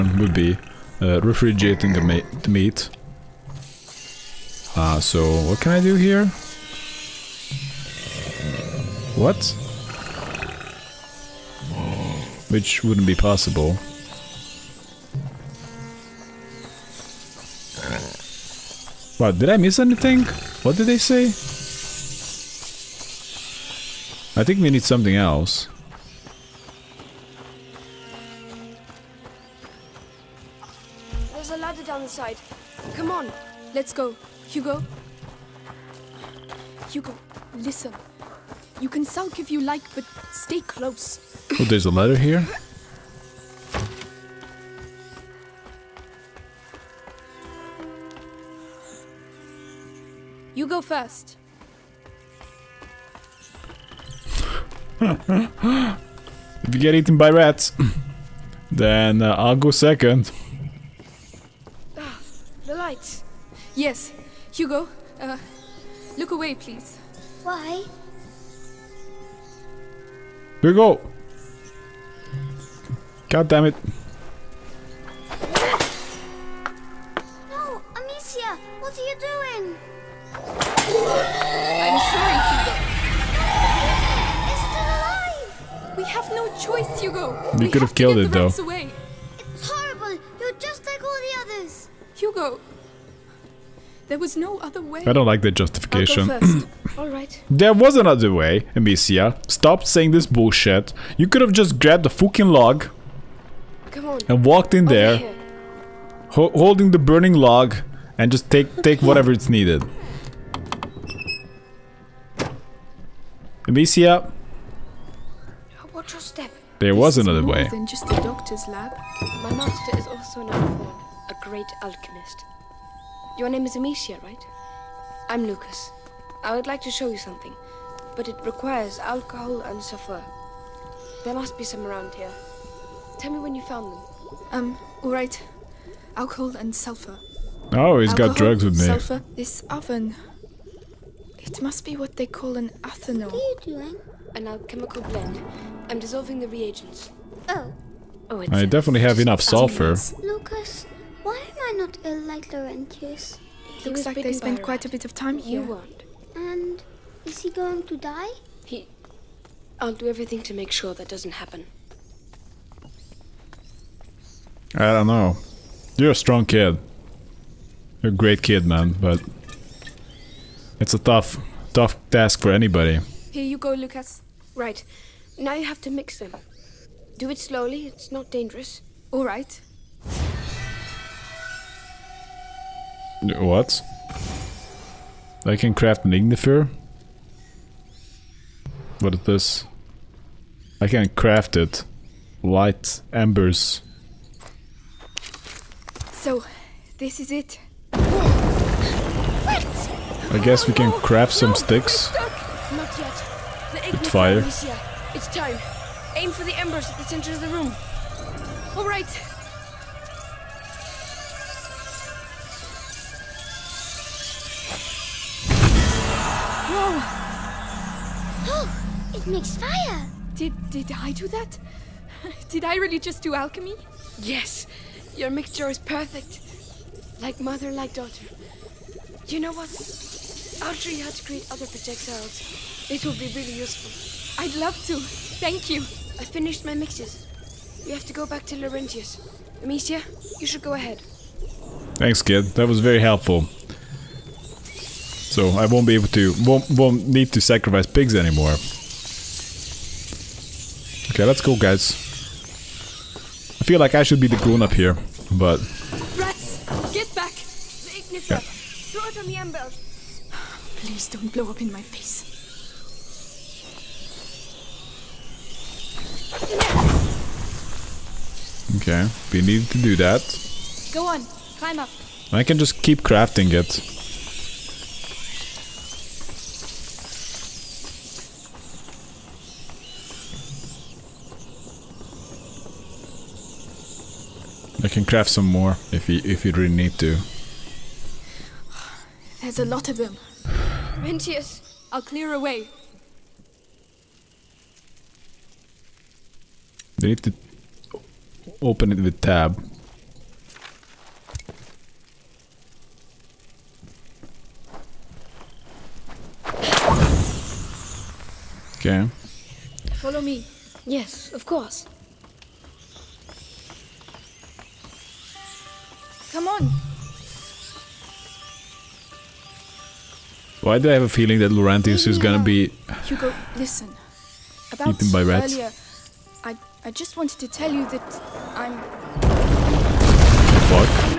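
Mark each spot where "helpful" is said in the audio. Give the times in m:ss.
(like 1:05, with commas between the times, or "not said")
4:02.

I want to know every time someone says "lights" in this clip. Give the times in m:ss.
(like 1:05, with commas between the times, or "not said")
1:02, 3:12.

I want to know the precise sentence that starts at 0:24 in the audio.
I think we need something else.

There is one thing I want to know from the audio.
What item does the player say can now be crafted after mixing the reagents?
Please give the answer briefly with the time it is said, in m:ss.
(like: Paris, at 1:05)
An ignifer, at 3:06.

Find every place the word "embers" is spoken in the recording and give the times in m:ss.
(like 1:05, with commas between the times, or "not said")
3:13, 3:26, 4:19.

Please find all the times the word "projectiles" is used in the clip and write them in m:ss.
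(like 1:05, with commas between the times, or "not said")
3:51.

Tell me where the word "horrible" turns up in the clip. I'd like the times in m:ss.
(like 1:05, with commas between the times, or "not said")
1:29.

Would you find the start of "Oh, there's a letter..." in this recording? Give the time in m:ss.
0:41.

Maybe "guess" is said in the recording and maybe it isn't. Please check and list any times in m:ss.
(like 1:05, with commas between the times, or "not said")
3:20.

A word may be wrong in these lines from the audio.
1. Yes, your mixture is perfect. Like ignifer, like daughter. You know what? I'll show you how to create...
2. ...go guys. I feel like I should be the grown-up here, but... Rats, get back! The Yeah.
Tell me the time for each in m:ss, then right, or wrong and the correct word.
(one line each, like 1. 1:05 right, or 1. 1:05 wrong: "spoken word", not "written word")
1. 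3:44 wrong: "mother", not "ignifer"
2. 4:11 right.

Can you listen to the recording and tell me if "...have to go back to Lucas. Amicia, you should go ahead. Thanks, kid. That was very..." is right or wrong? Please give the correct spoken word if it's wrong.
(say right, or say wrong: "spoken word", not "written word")
wrong: "Laurentius", not "Lucas".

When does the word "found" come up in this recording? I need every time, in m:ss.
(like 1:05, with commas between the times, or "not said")
2:13.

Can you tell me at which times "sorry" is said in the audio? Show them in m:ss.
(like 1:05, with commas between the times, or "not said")
1:22.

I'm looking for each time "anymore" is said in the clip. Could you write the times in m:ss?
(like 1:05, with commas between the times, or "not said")
4:08.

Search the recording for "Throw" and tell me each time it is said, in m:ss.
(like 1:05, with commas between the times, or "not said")
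4:18.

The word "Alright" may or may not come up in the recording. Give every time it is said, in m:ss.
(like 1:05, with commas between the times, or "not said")
1:36, 2:59.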